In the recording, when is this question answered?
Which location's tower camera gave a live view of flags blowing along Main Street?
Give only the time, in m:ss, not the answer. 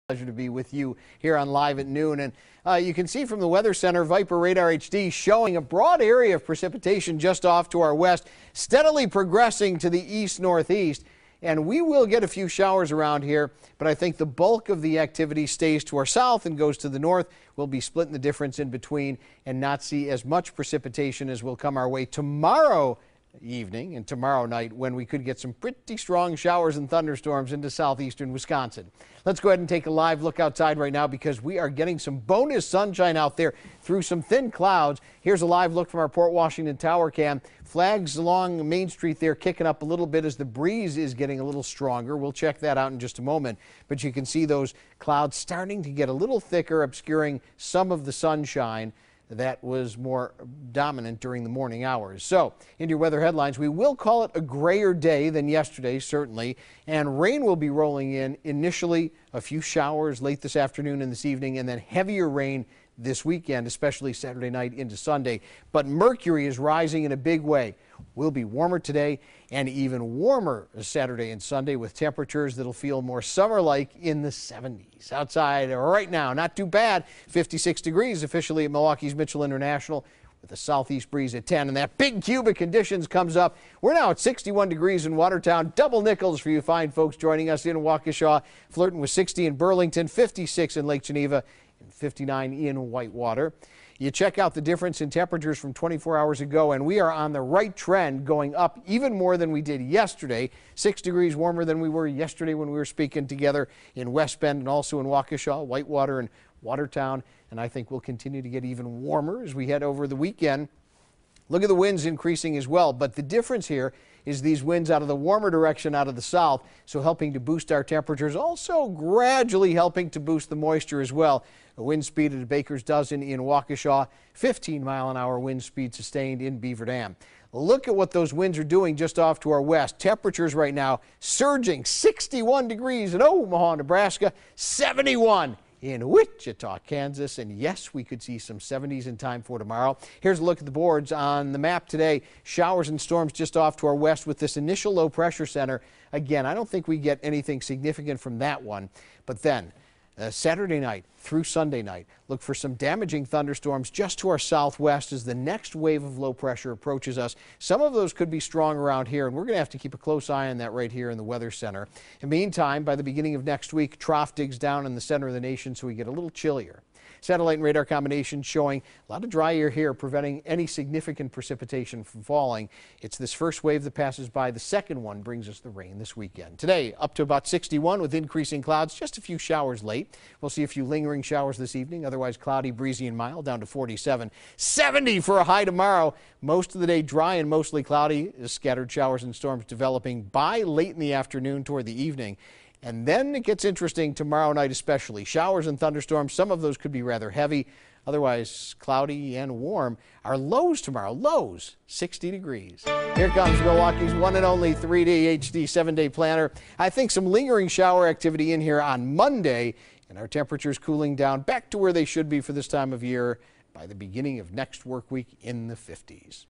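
0:36.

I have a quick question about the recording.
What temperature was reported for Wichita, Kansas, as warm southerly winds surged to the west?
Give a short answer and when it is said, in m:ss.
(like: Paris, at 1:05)
71, at 2:14.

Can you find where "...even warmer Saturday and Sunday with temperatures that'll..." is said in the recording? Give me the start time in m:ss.
1:09.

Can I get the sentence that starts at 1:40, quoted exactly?
Six degrees warmer than we were yesterday when we were speaking together in West Bend and also in Waukesha, Whitewater, and Watertown.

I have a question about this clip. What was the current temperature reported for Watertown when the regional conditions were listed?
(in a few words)
61 degrees.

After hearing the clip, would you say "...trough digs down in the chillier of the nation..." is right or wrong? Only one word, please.
wrong.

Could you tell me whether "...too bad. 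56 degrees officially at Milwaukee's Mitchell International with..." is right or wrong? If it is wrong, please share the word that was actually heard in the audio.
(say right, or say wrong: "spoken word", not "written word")
right.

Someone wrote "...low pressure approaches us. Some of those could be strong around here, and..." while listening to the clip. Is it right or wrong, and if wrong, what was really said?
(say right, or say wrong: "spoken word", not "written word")
right.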